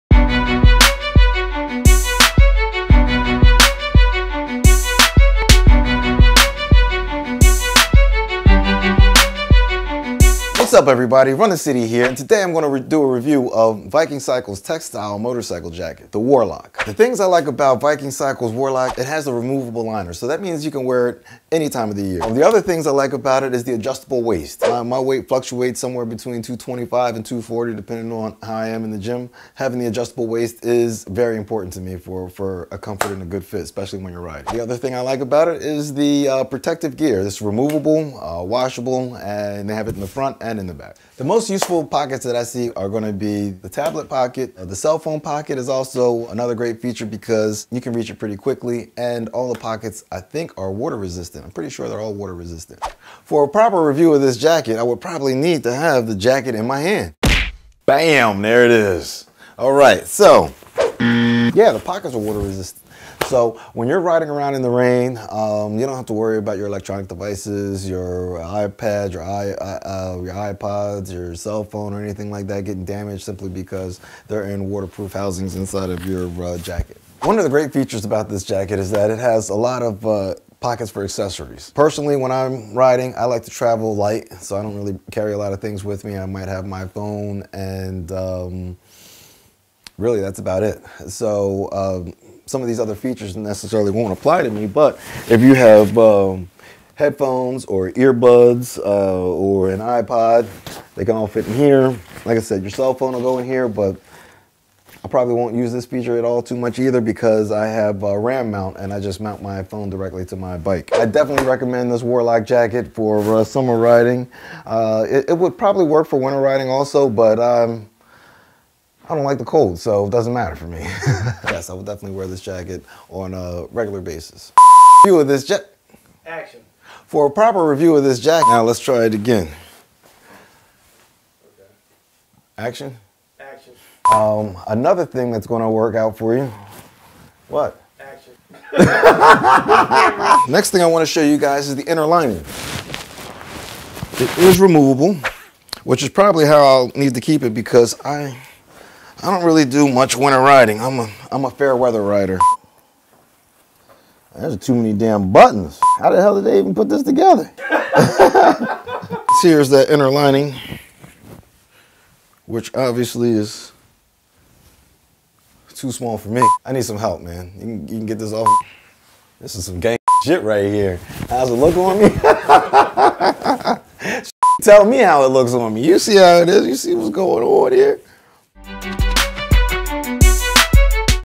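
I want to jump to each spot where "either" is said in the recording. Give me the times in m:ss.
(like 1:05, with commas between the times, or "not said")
1:46.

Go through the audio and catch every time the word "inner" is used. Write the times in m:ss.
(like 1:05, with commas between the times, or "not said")
2:21, 2:39.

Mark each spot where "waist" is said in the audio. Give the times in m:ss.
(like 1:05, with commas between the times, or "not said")
0:24, 0:30.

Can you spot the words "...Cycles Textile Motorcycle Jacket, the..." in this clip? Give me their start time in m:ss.
0:14.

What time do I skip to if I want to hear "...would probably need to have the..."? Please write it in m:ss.
0:54.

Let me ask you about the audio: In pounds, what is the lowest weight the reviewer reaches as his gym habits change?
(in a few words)
225.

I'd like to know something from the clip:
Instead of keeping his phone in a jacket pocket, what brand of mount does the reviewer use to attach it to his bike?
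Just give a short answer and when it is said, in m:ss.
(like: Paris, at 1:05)
RAM, at 1:48.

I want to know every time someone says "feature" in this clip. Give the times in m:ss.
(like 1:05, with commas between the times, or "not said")
0:46, 1:17, 1:32, 1:45.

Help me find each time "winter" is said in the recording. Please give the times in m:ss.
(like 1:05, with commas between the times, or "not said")
1:56, 2:30.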